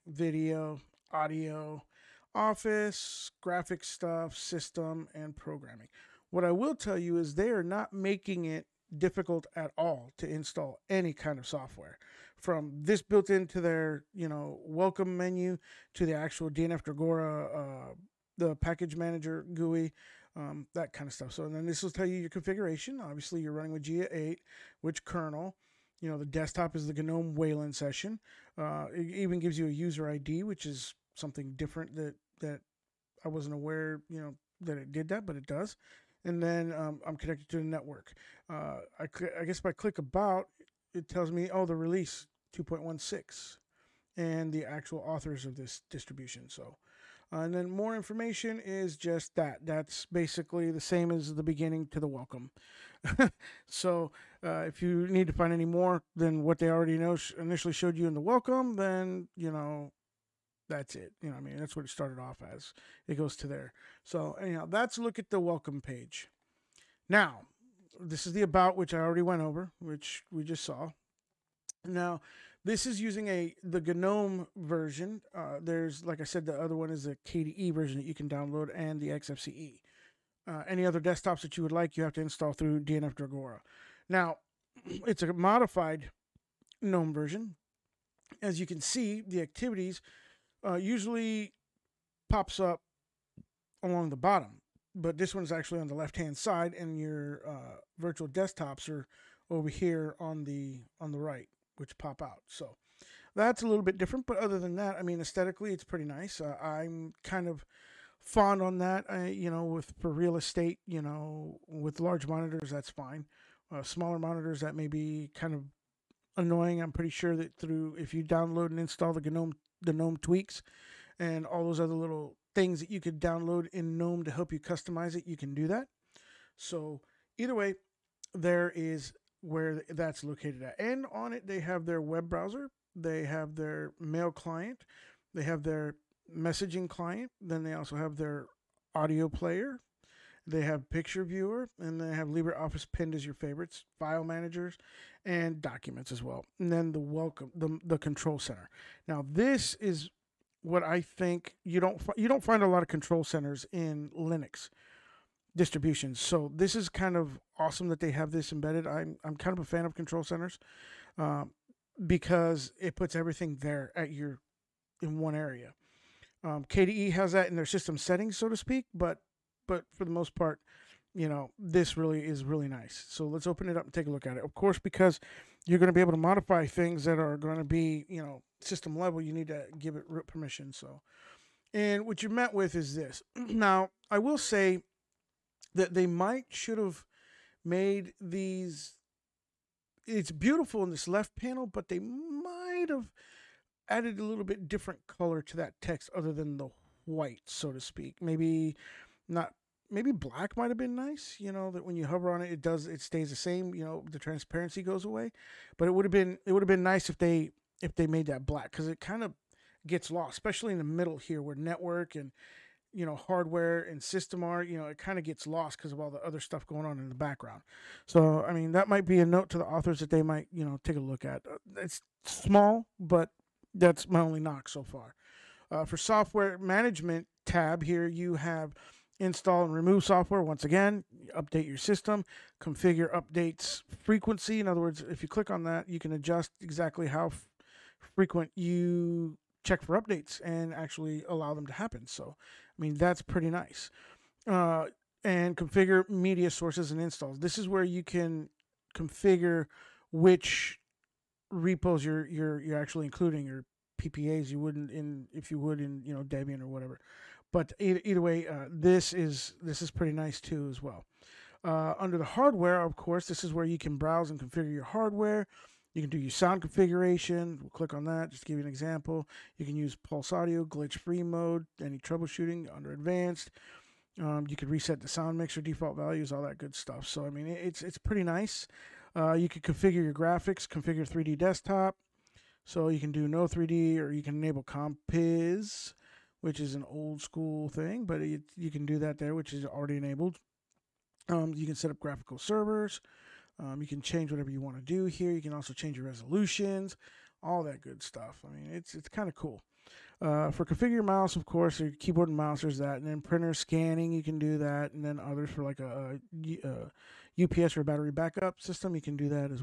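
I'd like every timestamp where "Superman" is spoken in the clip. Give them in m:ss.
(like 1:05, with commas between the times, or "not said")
not said.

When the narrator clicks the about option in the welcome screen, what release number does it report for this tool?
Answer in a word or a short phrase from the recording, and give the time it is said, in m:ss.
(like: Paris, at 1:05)
2.16, at 0:41.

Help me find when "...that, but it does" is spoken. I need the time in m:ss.
0:35.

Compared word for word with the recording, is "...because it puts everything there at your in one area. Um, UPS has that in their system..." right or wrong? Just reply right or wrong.
wrong.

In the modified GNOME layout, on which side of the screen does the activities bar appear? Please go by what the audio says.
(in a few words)
left hand side.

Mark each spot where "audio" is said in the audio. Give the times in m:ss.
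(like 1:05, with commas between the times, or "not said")
0:01, 2:18, 4:30.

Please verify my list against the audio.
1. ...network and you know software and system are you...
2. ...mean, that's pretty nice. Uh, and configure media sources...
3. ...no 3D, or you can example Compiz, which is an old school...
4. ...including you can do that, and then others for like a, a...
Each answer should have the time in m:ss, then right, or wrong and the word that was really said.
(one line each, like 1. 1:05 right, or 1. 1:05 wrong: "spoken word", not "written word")
1. 3:31 wrong: "hardware", not "software"
2. 4:02 right
3. 4:43 wrong: "enable", not "example"
4. 5:03 wrong: "scanning", not "including".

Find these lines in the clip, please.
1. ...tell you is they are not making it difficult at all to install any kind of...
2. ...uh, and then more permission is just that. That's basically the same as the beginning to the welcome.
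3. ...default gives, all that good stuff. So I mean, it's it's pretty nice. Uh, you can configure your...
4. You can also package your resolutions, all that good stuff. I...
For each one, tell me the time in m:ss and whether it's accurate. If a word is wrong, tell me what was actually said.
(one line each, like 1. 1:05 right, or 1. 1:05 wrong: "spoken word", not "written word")
1. 0:06 right
2. 0:47 wrong: "information", not "permission"
3. 4:35 wrong: "values", not "gives"
4. 4:55 wrong: "change", not "package".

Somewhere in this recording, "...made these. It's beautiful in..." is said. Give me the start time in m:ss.
3:07.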